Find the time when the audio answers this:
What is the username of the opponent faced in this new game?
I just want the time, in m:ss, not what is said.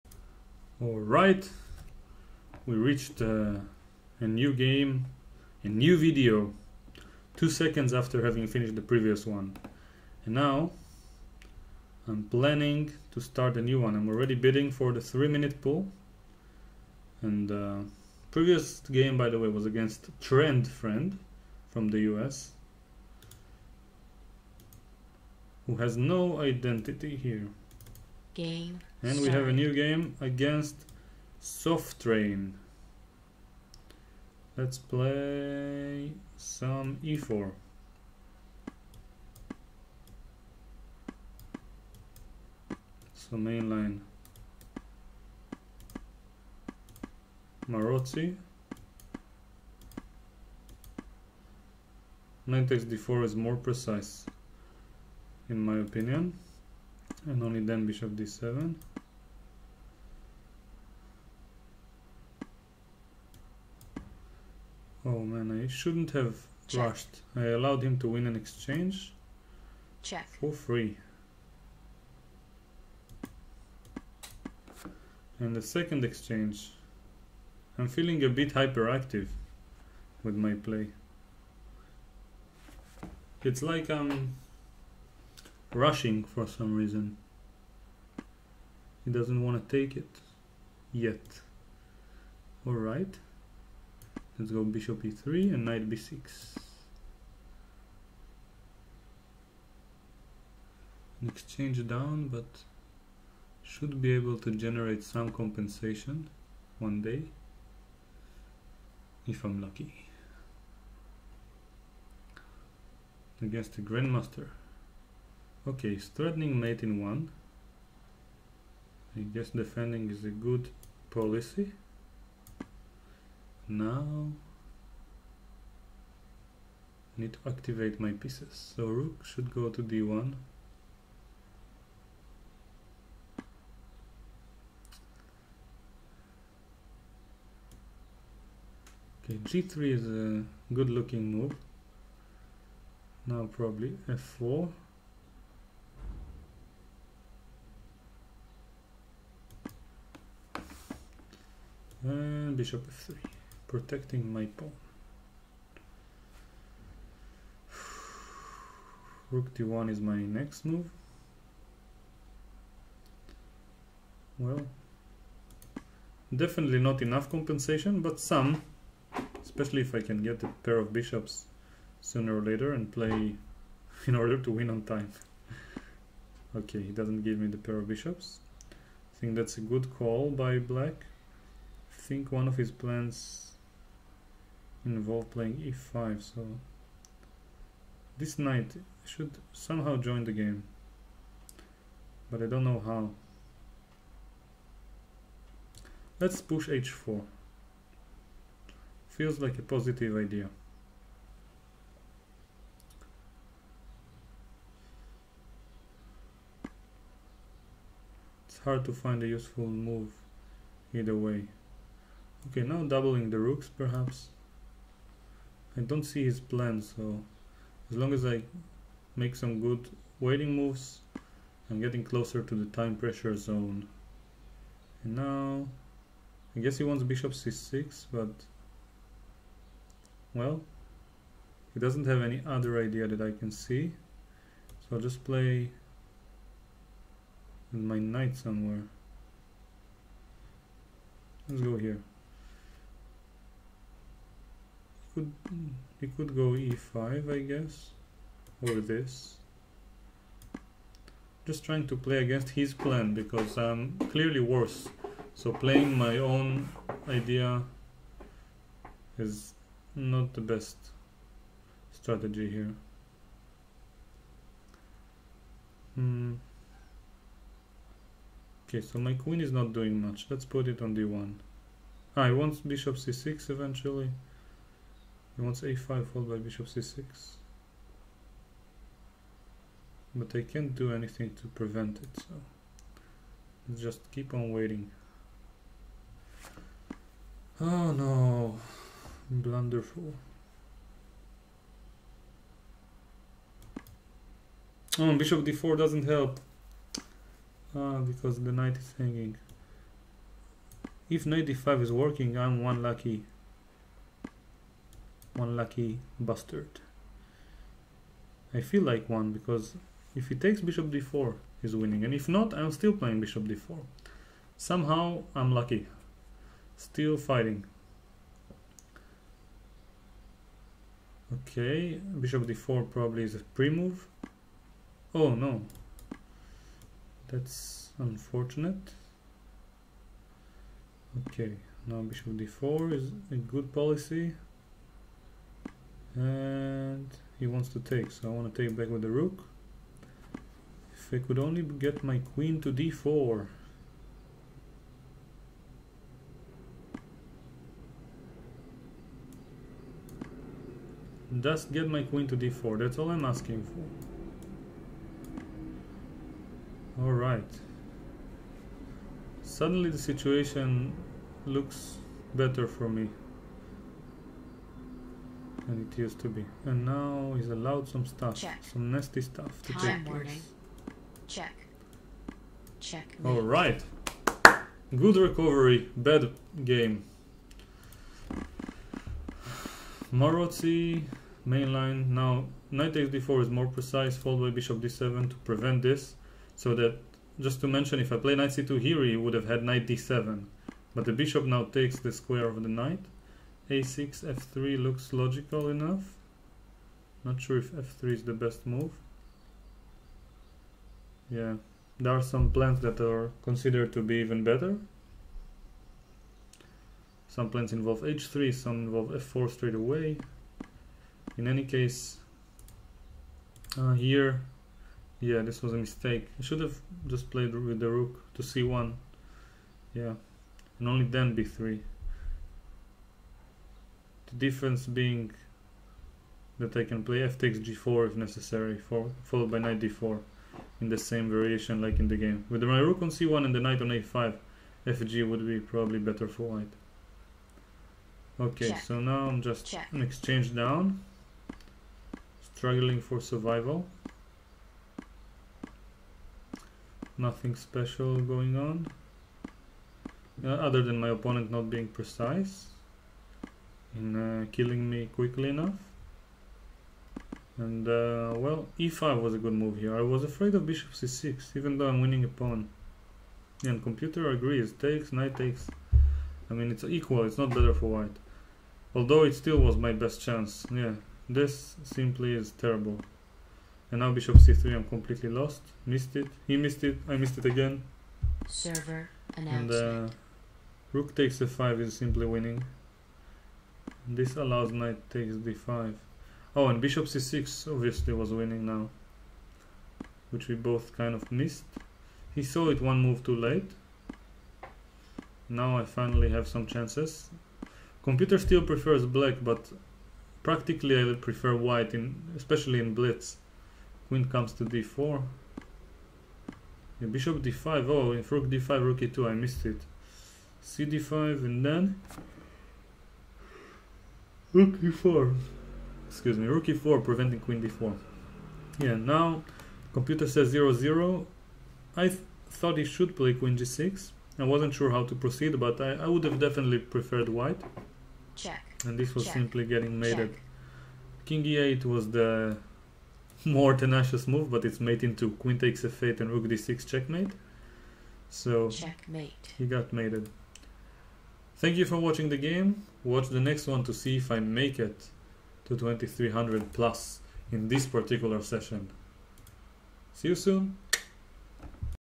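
0:31.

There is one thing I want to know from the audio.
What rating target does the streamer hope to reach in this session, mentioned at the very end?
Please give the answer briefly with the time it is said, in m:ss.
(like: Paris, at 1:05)
2300 plus, at 9:05.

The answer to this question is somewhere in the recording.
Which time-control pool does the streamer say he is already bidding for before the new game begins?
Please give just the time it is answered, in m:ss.
0:15.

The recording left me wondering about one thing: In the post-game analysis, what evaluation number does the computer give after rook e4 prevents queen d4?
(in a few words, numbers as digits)
0 0.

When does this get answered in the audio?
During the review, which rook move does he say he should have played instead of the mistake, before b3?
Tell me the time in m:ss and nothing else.
6:57.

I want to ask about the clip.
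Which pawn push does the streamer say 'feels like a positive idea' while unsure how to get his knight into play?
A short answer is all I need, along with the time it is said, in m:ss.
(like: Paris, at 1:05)
h4, at 3:16.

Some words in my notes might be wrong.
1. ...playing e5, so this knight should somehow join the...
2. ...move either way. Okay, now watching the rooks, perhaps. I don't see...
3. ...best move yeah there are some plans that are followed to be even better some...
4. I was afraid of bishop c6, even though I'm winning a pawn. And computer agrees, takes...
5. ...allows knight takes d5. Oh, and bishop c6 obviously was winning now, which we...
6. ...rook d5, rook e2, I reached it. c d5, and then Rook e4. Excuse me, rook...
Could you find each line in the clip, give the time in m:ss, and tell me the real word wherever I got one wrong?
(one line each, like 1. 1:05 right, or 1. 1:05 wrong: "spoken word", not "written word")
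1. 3:05 right
2. 3:29 wrong: "doubling", not "watching"
3. 6:38 wrong: "considered", not "followed"
4. 7:39 right
5. 8:04 right
6. 8:28 wrong: "missed", not "reached".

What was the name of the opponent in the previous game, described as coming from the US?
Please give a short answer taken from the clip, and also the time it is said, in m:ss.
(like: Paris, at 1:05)
Trend Friend, at 0:20.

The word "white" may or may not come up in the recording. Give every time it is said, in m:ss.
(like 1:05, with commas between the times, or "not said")
7:16, 7:47, 8:21, 8:47.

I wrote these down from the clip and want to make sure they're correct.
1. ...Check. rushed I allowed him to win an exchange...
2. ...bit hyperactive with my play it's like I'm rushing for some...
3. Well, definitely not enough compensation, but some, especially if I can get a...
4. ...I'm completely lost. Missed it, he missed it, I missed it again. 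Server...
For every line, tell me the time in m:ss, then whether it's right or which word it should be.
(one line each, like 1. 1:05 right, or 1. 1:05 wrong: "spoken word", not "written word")
1. 1:06 right
2. 1:18 right
3. 2:44 right
4. 7:54 right.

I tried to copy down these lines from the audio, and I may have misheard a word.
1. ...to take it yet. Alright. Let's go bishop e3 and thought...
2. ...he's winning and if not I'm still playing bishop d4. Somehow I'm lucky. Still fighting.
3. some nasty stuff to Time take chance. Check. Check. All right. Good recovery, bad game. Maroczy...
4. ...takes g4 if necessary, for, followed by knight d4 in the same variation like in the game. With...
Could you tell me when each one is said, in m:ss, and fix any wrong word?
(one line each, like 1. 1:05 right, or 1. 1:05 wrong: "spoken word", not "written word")
1. 1:29 wrong: "knight", not "thought"
2. 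5:11 right
3. 6:08 wrong: "place", not "chance"
4. 7:07 right.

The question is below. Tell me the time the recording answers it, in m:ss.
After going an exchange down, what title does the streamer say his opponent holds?
1:53.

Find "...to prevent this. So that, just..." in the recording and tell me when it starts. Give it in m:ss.
6:25.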